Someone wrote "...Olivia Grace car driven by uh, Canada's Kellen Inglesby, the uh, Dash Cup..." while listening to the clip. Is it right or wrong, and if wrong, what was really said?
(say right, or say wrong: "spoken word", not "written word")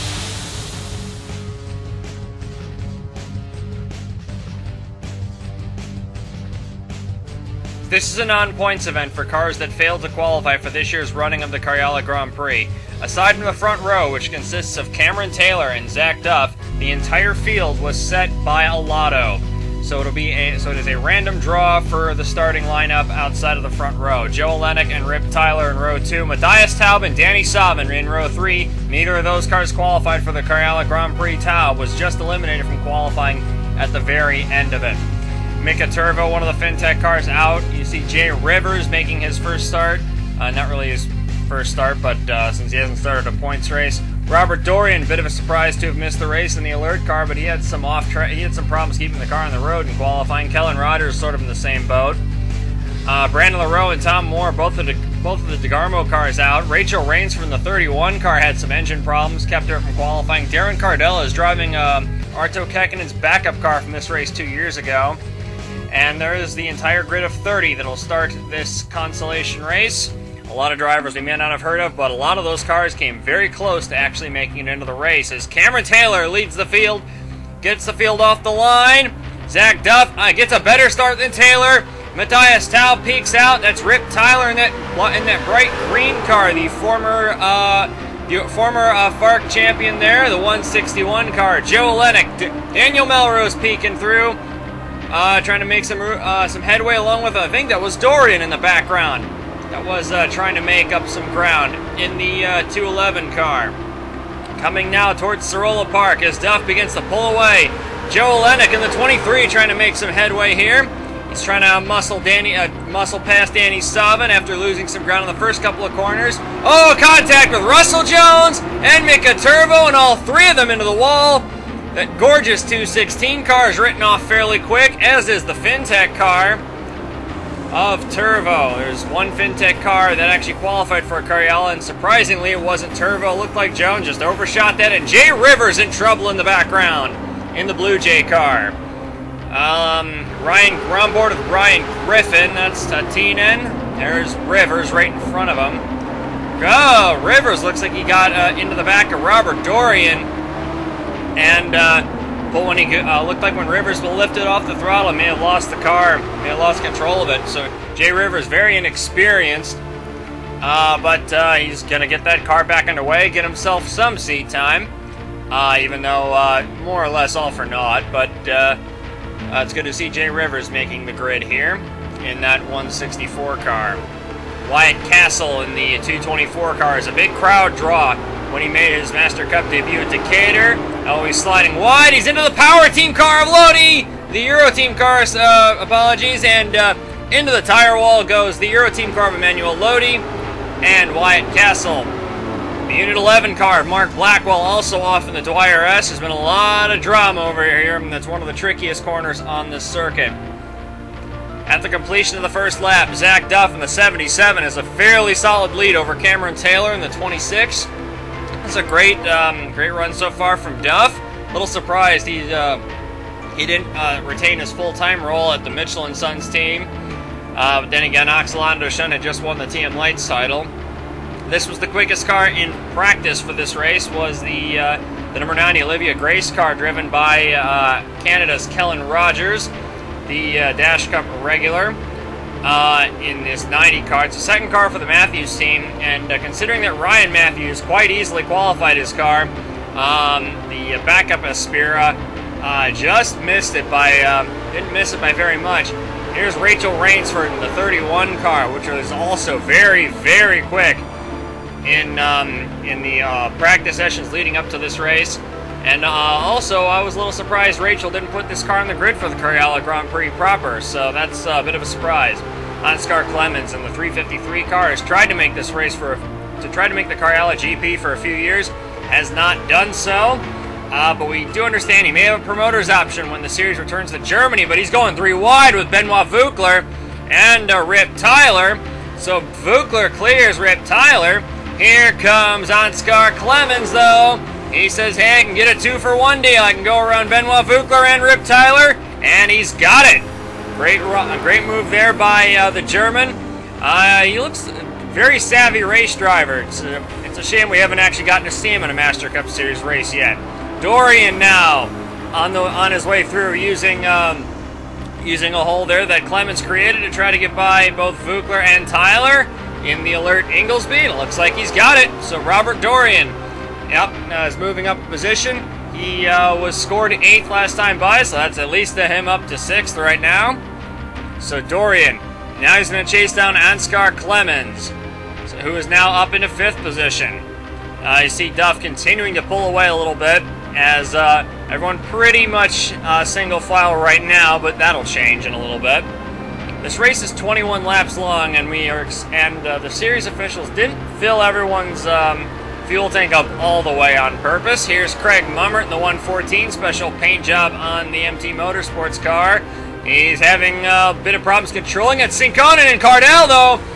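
wrong: "Rogers", not "Inglesby".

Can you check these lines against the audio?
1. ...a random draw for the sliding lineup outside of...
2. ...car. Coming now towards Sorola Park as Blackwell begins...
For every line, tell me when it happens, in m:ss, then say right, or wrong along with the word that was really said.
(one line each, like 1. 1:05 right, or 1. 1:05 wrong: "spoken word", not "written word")
1. 0:20 wrong: "starting", not "sliding"
2. 1:43 wrong: "Duff", not "Blackwell".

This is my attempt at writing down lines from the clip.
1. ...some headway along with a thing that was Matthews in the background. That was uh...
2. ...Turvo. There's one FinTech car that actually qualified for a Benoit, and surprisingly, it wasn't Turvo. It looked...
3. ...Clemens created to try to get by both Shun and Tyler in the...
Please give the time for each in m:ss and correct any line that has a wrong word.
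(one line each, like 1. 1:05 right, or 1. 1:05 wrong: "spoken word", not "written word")
1. 1:36 wrong: "Dorian", not "Matthews"
2. 2:08 wrong: "Karjala", not "Benoit"
3. 5:06 wrong: "Vukler", not "Shun".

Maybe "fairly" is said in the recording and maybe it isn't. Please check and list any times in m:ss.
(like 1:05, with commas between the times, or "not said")
2:04, 3:24.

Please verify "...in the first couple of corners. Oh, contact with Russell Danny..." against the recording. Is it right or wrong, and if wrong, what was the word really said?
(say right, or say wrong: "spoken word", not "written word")
wrong: "Jones", not "Danny".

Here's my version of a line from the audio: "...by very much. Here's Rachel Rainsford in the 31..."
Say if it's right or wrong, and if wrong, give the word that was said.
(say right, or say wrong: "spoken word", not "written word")
right.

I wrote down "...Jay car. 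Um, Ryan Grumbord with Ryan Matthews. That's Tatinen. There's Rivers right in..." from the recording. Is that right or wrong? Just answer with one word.
wrong.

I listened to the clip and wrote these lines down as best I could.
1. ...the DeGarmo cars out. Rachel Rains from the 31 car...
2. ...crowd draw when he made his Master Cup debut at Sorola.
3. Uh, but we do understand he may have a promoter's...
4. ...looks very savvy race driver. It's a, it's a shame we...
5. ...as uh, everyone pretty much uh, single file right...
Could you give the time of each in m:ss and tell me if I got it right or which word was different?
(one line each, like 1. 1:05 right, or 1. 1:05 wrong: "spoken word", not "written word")
1. 0:55 right
2. 2:57 wrong: "Decatur", not "Sorola"
3. 4:30 right
4. 4:54 right
5. 5:30 right.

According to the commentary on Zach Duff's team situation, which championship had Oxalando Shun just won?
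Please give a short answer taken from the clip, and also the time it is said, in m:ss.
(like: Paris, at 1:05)
TM Lights title, at 3:39.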